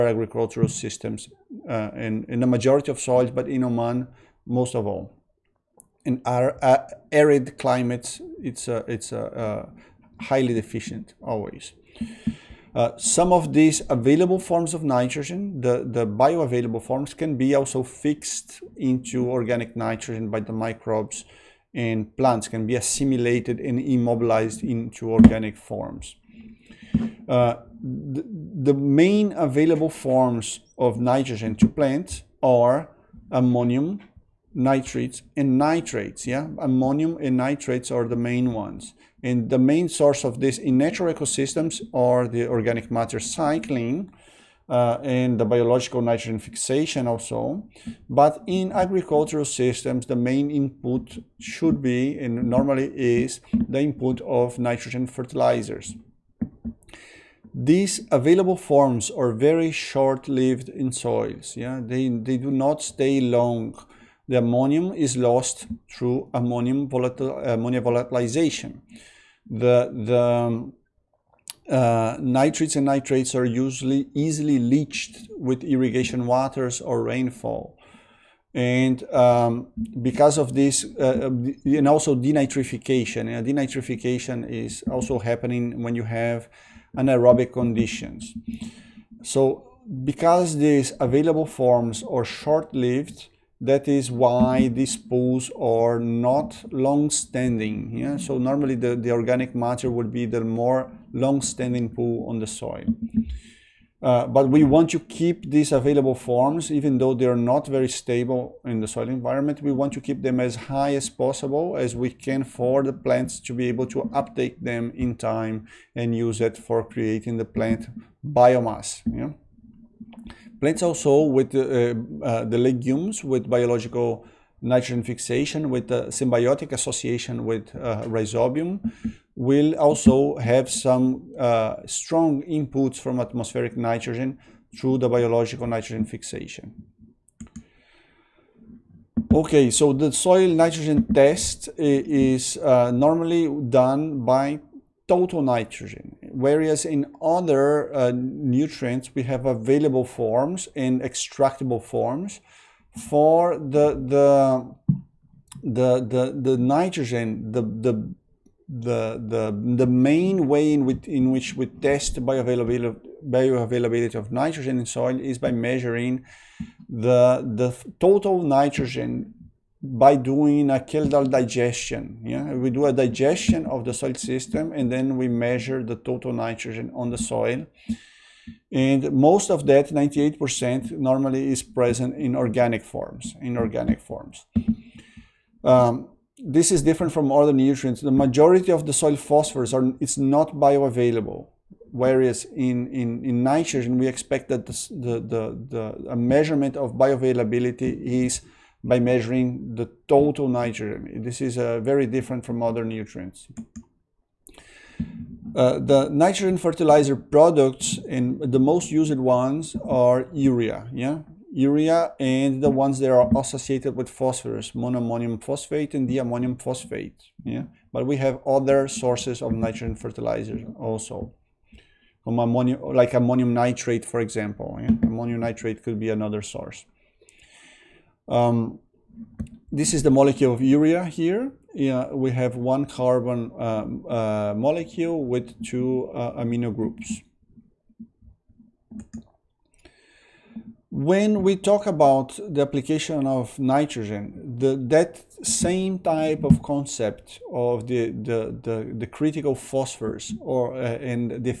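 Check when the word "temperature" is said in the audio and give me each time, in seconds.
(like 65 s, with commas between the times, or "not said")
not said.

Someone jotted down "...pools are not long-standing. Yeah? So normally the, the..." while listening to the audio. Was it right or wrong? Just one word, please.
right.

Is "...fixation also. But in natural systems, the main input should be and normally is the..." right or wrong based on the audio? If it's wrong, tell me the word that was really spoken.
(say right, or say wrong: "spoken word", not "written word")
wrong: "agricultural", not "natural".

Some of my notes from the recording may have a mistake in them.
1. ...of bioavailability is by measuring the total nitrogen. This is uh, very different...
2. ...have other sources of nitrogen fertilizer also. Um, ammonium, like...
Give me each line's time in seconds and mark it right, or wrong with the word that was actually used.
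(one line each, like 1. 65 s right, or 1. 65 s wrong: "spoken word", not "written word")
1. 196 s right
2. 218 s right.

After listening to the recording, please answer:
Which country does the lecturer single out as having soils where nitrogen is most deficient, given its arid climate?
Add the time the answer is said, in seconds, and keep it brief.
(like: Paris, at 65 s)
Oman, at 3 s.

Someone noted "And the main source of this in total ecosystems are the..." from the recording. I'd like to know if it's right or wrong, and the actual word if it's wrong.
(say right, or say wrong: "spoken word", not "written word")
wrong: "natural", not "total".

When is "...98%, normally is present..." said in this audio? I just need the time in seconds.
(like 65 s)
179 s.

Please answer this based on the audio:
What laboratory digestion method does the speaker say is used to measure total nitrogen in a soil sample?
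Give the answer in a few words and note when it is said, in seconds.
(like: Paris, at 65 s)
Kjeldahl digestion, at 170 s.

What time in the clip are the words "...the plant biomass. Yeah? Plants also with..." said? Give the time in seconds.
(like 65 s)
117 s.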